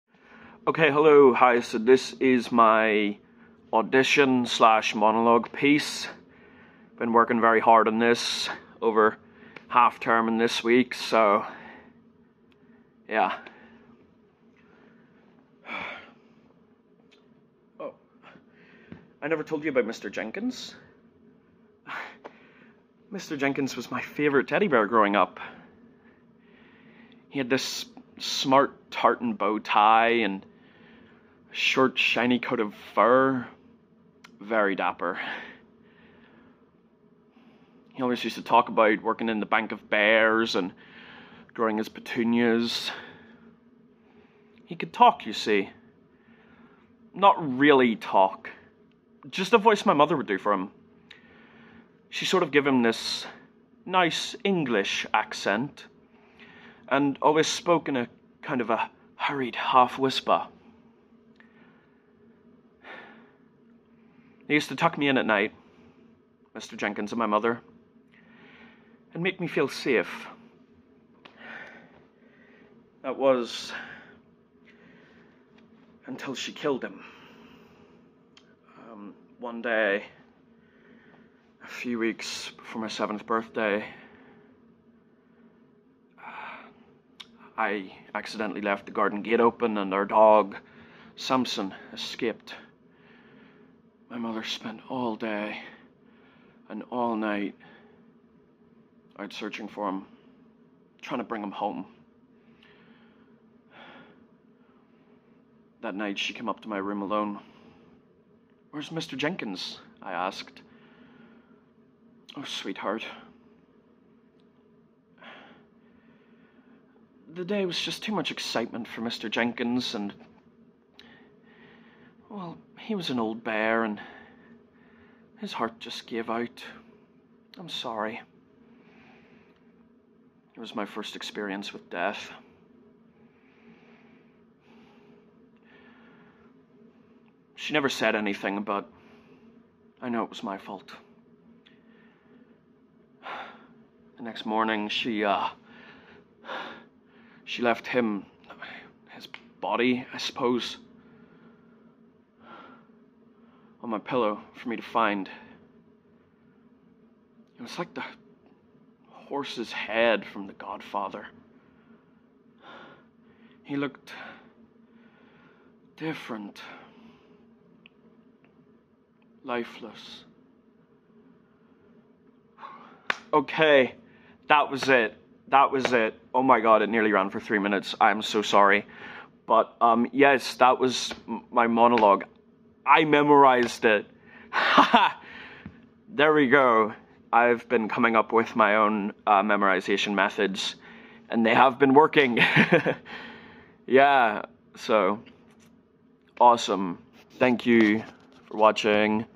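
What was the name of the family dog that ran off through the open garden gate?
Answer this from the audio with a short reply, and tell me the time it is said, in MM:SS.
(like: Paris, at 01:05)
Samson, at 01:31.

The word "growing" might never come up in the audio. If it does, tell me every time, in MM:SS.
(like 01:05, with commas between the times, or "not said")
00:24, 00:41.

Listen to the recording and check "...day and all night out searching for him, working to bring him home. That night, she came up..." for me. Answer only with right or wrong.
wrong.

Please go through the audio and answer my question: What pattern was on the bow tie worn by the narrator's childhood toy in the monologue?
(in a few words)
Tartan.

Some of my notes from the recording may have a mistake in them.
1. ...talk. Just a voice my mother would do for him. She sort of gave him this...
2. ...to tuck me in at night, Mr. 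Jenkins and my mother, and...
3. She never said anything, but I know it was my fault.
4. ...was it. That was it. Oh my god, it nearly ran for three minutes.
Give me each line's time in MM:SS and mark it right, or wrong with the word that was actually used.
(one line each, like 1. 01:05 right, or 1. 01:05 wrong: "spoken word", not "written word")
1. 00:47 right
2. 01:04 right
3. 02:17 right
4. 02:54 right.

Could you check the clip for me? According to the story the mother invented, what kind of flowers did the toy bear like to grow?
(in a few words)
Petunias.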